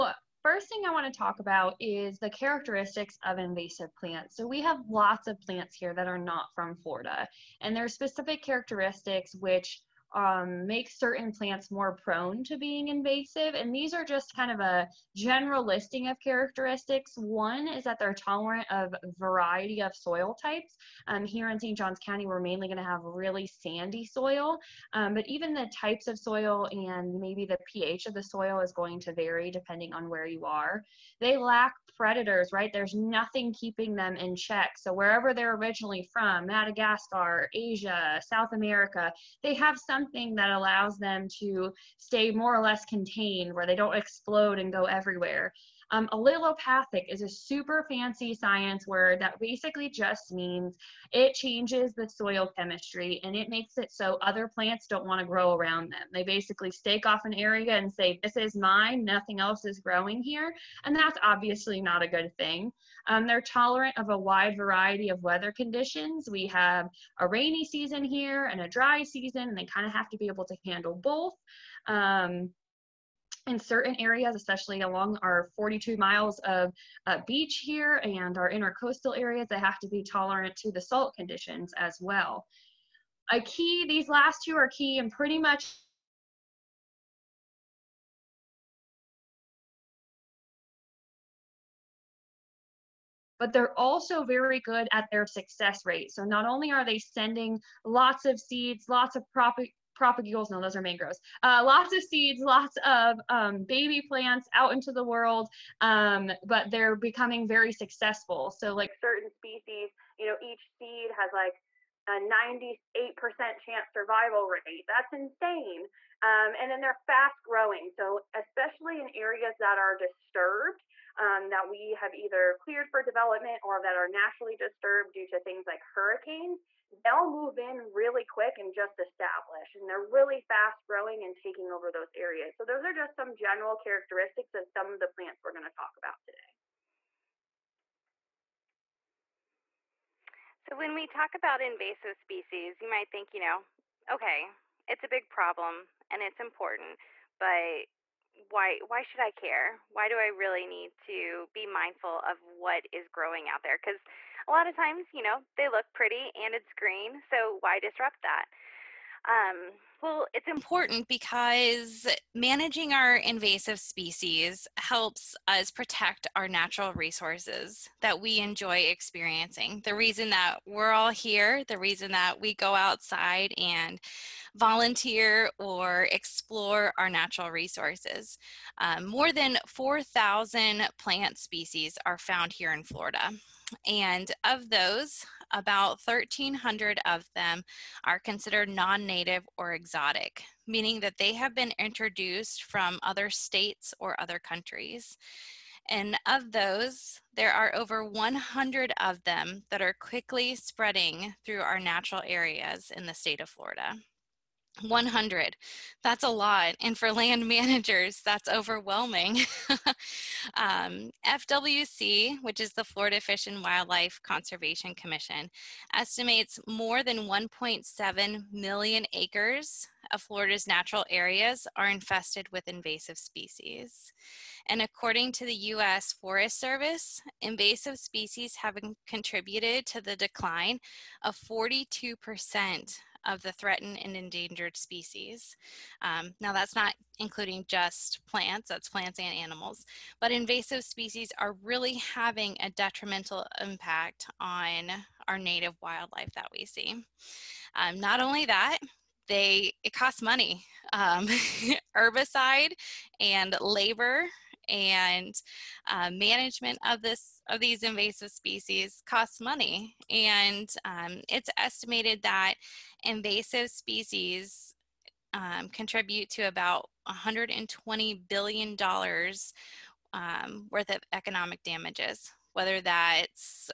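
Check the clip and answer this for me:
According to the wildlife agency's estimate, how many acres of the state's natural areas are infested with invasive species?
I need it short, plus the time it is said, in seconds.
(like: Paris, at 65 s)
1.7 million, at 217 s.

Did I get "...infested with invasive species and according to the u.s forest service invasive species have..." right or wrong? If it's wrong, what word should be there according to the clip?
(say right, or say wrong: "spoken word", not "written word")
right.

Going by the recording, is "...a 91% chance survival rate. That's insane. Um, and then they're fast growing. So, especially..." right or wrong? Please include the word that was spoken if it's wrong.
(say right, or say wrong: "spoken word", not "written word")
wrong: "98", not "91".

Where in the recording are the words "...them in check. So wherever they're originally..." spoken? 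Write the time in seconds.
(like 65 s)
33 s.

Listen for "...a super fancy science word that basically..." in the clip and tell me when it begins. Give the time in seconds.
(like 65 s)
47 s.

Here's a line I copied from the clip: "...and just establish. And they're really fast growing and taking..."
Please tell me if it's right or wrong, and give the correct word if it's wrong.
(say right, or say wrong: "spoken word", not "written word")
right.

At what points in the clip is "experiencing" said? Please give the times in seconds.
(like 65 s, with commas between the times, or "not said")
168 s.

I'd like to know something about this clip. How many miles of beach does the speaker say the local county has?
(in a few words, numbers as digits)
42.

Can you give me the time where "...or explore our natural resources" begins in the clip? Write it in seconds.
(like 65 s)
175 s.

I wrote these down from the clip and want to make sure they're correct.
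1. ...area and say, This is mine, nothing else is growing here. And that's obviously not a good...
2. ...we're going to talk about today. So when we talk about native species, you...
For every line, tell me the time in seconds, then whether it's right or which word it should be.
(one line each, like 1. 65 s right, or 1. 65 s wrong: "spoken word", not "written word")
1. 57 s right
2. 135 s wrong: "invasive", not "native".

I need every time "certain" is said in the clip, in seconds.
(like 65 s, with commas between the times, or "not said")
10 s, 73 s, 108 s.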